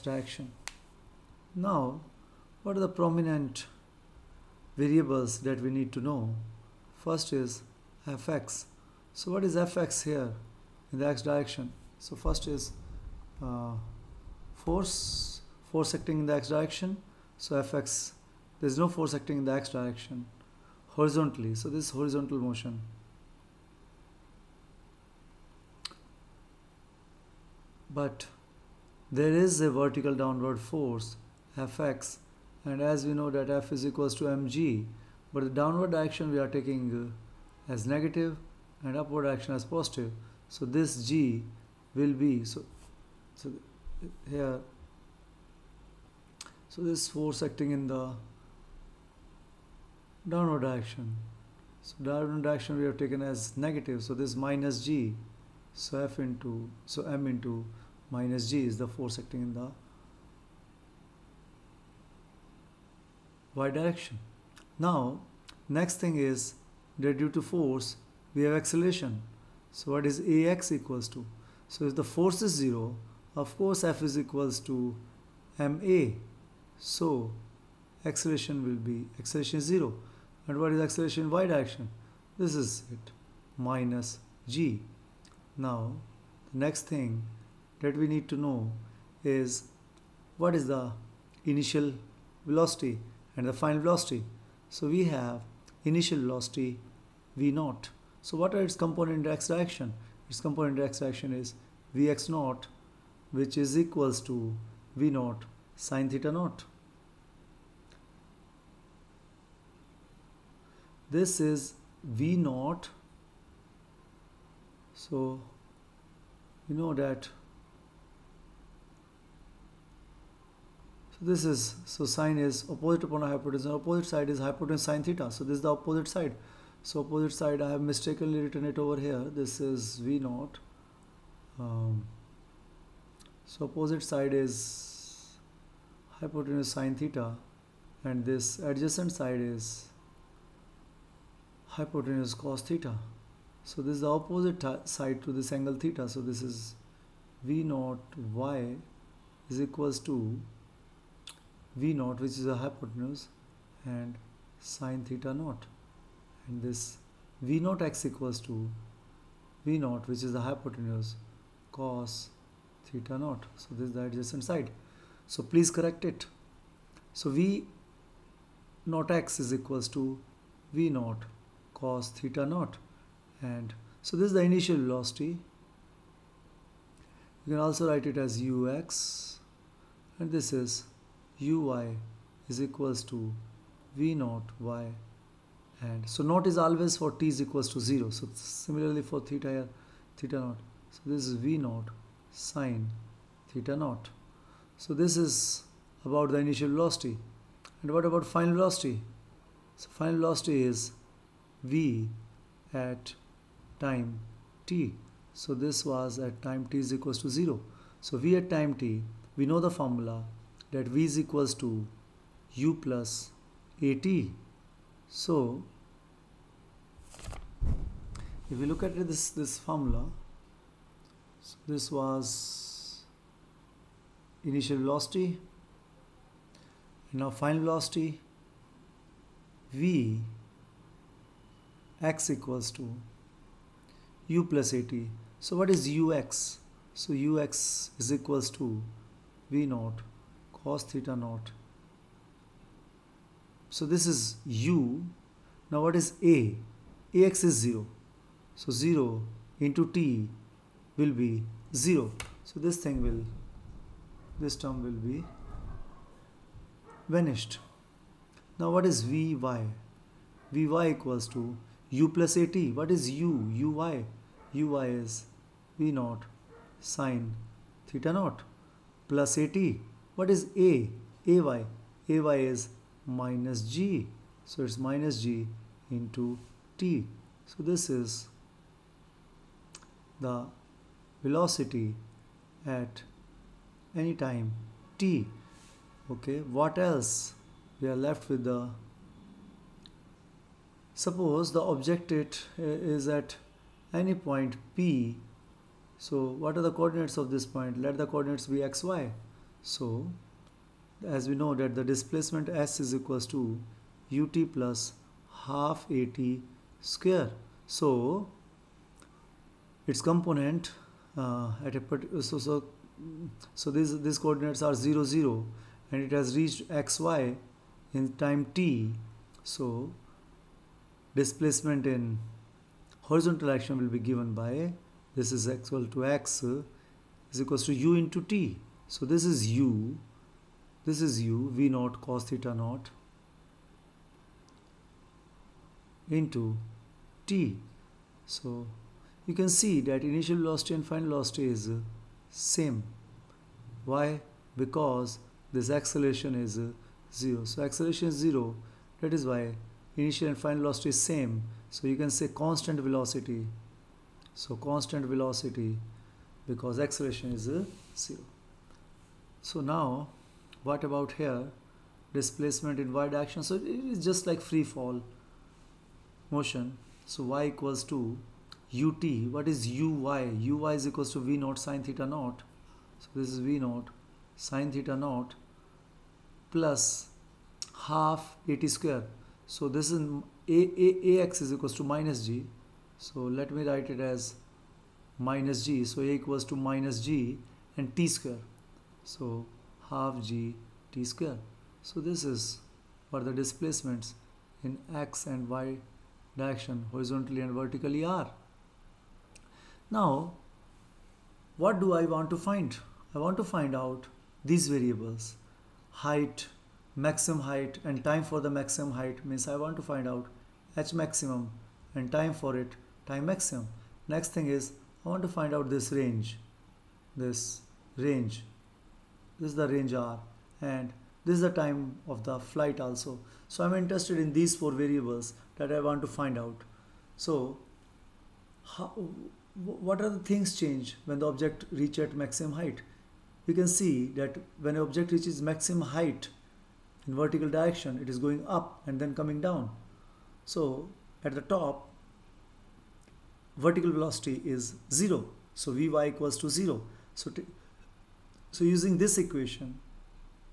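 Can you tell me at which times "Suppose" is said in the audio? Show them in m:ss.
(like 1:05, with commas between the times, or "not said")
4:50.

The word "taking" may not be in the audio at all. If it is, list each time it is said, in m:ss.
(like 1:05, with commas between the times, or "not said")
0:36.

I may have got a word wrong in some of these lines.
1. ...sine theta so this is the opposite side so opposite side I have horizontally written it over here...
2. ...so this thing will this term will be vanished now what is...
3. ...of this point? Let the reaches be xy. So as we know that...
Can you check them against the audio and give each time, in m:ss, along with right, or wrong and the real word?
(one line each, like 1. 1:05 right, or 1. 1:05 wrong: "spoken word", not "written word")
1. 2:04 wrong: "mistakenly", not "horizontally"
2. 4:12 right
3. 4:57 wrong: "coordinates", not "reaches".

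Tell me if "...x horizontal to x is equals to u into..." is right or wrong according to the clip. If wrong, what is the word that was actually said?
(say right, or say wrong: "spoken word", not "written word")
wrong: "equal", not "horizontal".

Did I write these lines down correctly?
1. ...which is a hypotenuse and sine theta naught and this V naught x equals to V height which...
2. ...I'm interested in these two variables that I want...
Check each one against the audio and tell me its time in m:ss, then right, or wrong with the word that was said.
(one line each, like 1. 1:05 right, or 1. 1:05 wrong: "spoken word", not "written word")
1. 2:32 wrong: "naught", not "height"
2. 7:03 wrong: "four", not "two".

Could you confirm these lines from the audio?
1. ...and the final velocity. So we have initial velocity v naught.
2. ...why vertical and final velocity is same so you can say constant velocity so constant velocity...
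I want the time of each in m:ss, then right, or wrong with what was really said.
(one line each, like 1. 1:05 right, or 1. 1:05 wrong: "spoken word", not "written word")
1. 1:33 right
2. 5:49 wrong: "initial", not "vertical".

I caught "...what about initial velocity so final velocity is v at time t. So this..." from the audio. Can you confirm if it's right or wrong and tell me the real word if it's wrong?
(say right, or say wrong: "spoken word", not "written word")
wrong: "final", not "initial".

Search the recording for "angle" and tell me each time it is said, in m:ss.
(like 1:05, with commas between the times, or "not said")
2:25.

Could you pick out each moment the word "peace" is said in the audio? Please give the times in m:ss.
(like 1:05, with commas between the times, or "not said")
not said.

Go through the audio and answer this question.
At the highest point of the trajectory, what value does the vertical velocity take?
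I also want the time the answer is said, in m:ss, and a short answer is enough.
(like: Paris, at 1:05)
0, at 7:23.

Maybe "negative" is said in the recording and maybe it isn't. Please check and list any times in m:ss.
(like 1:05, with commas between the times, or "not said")
0:37, 0:53.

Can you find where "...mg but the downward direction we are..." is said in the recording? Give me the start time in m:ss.
0:34.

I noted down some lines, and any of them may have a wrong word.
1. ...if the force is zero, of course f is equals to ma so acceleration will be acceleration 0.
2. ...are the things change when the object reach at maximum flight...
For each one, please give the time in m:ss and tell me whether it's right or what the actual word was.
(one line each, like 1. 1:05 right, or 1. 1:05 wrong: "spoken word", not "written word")
1. 1:11 right
2. 7:10 wrong: "height", not "flight".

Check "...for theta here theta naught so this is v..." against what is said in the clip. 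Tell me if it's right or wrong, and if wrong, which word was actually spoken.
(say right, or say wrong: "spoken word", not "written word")
right.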